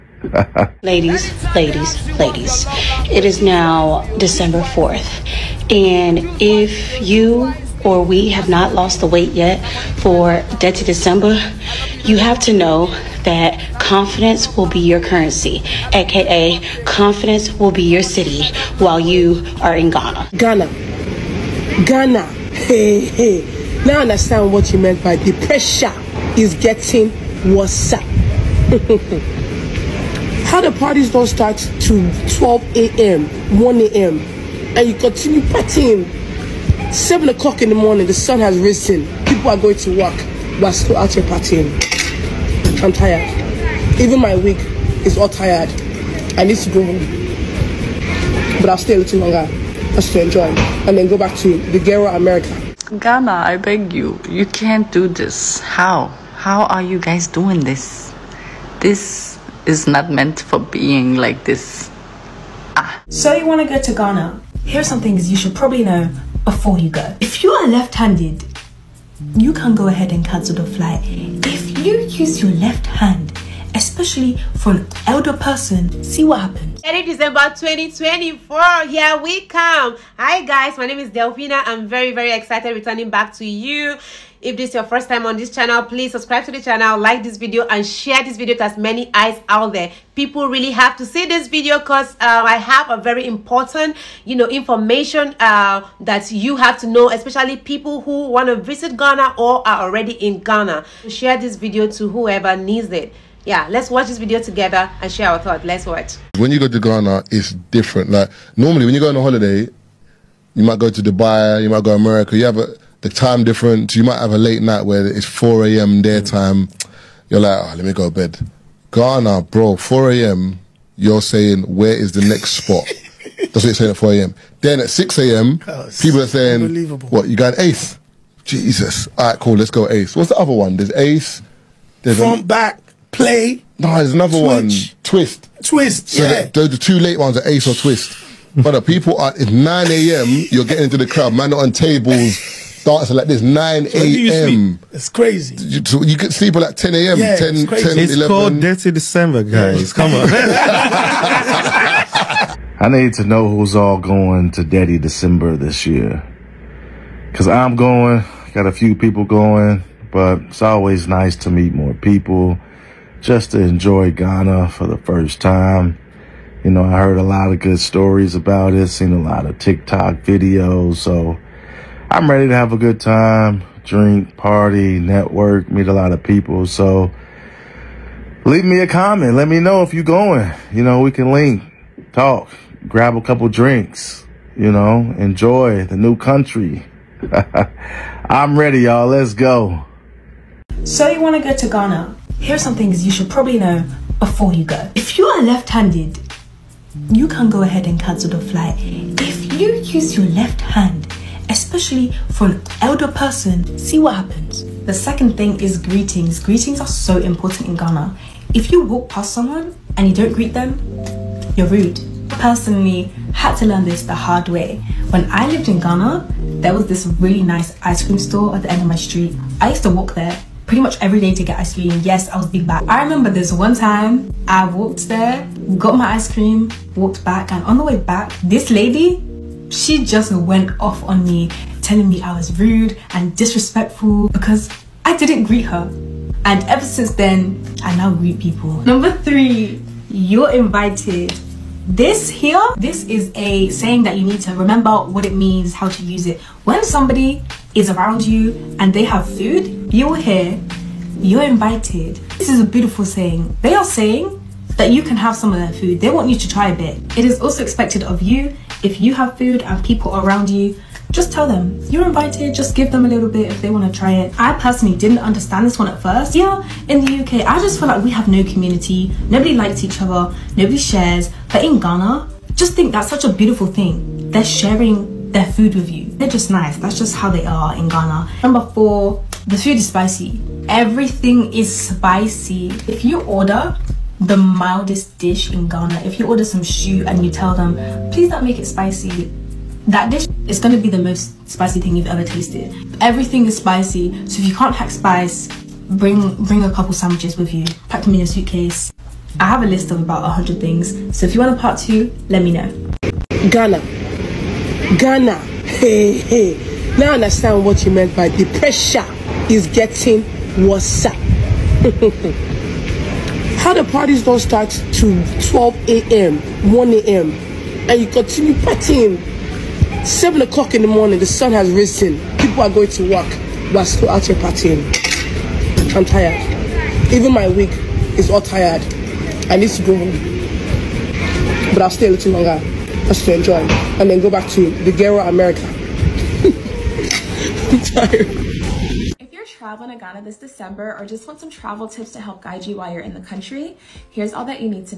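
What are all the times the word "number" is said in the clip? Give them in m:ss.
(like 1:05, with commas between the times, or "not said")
3:58, 4:38.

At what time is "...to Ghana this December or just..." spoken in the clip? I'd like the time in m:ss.
5:39.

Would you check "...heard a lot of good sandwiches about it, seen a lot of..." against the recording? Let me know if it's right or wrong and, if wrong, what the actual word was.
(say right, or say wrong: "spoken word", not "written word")
wrong: "stories", not "sandwiches".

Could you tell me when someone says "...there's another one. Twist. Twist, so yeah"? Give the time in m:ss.
2:13.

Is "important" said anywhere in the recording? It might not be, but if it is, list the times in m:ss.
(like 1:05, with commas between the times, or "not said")
1:33, 3:27.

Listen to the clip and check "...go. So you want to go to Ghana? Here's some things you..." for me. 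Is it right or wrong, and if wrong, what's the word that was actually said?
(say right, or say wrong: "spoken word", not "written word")
right.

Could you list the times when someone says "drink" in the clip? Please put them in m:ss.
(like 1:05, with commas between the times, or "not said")
2:53, 3:03.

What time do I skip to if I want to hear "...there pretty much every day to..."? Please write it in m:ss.
3:40.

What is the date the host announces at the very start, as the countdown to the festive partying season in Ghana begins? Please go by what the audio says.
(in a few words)
December 4th.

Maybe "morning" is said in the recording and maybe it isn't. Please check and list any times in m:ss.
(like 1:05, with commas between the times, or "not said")
0:37, 5:20.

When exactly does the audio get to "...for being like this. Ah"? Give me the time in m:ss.
1:00.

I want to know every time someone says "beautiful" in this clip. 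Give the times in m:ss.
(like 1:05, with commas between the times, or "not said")
4:12, 4:33.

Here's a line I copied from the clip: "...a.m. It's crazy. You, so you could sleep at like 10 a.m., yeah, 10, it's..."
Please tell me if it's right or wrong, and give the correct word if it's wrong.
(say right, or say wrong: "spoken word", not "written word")
right.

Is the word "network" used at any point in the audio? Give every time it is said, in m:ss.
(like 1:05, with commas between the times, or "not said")
2:54.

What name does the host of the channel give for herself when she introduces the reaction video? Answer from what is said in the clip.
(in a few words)
Delphina.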